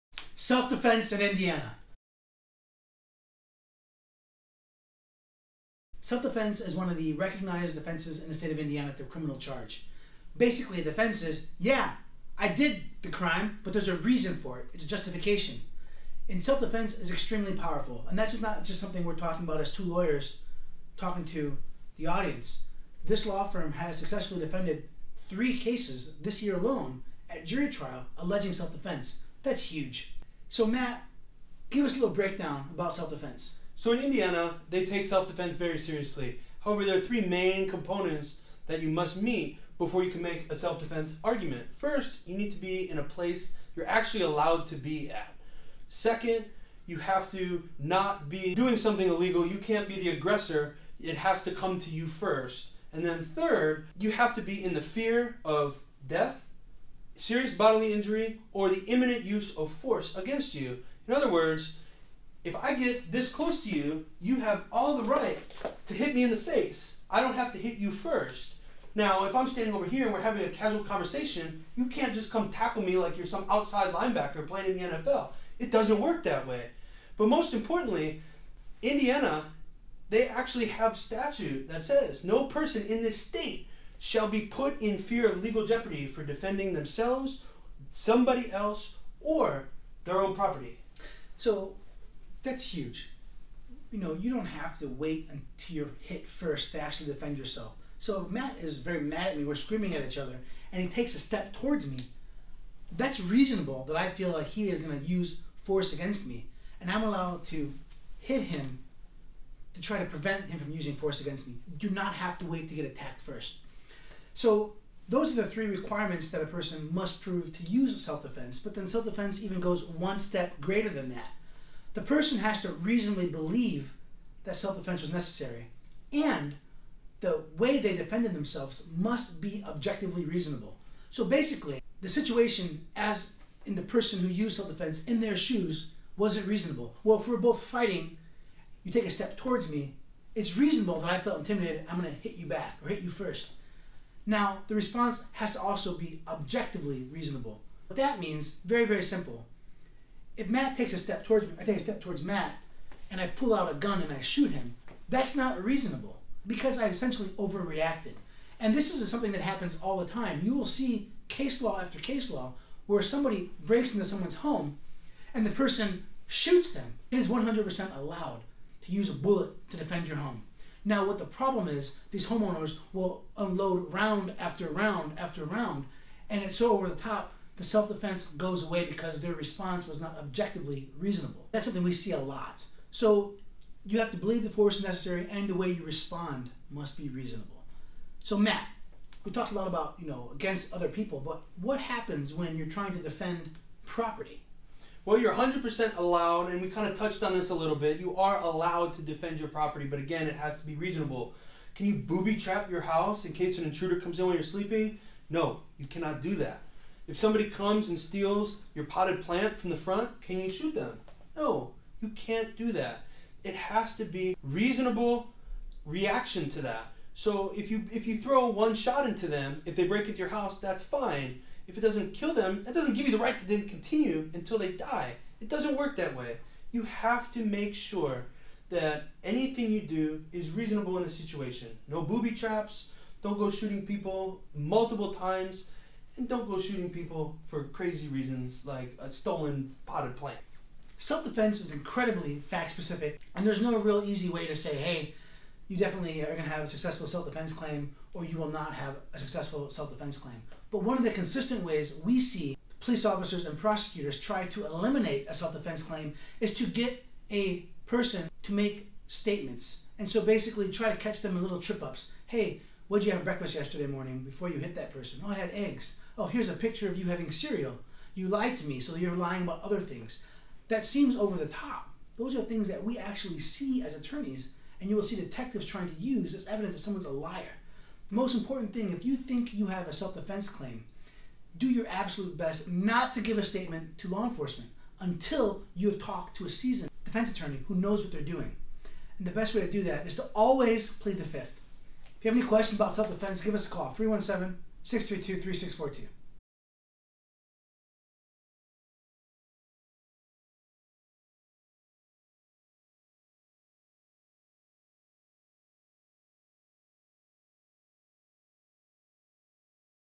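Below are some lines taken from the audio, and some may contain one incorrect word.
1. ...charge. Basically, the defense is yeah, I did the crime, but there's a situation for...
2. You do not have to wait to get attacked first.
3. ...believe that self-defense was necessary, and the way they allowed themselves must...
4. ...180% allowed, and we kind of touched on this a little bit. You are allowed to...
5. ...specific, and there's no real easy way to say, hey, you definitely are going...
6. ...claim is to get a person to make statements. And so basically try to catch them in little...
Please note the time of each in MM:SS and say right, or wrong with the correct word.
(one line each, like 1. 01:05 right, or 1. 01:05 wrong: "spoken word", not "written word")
1. 00:09 wrong: "reason", not "situation"
2. 01:51 right
3. 02:03 wrong: "defended", not "allowed"
4. 03:15 wrong: "100", not "180"
5. 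04:02 right
6. 04:15 right.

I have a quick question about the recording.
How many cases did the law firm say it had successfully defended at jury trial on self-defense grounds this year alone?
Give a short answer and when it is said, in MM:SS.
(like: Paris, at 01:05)
3, at 00:25.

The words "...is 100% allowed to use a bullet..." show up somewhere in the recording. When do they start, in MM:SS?
02:47.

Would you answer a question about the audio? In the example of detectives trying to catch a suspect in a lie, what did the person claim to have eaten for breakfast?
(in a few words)
Eggs.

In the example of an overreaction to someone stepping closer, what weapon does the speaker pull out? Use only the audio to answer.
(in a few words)
A gun.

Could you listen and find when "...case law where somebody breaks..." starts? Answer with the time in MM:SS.
02:41.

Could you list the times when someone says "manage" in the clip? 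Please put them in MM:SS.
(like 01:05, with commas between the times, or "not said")
not said.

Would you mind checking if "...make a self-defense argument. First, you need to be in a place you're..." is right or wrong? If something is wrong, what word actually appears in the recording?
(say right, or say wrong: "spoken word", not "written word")
right.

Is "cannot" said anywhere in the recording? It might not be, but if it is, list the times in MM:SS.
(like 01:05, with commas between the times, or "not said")
03:25.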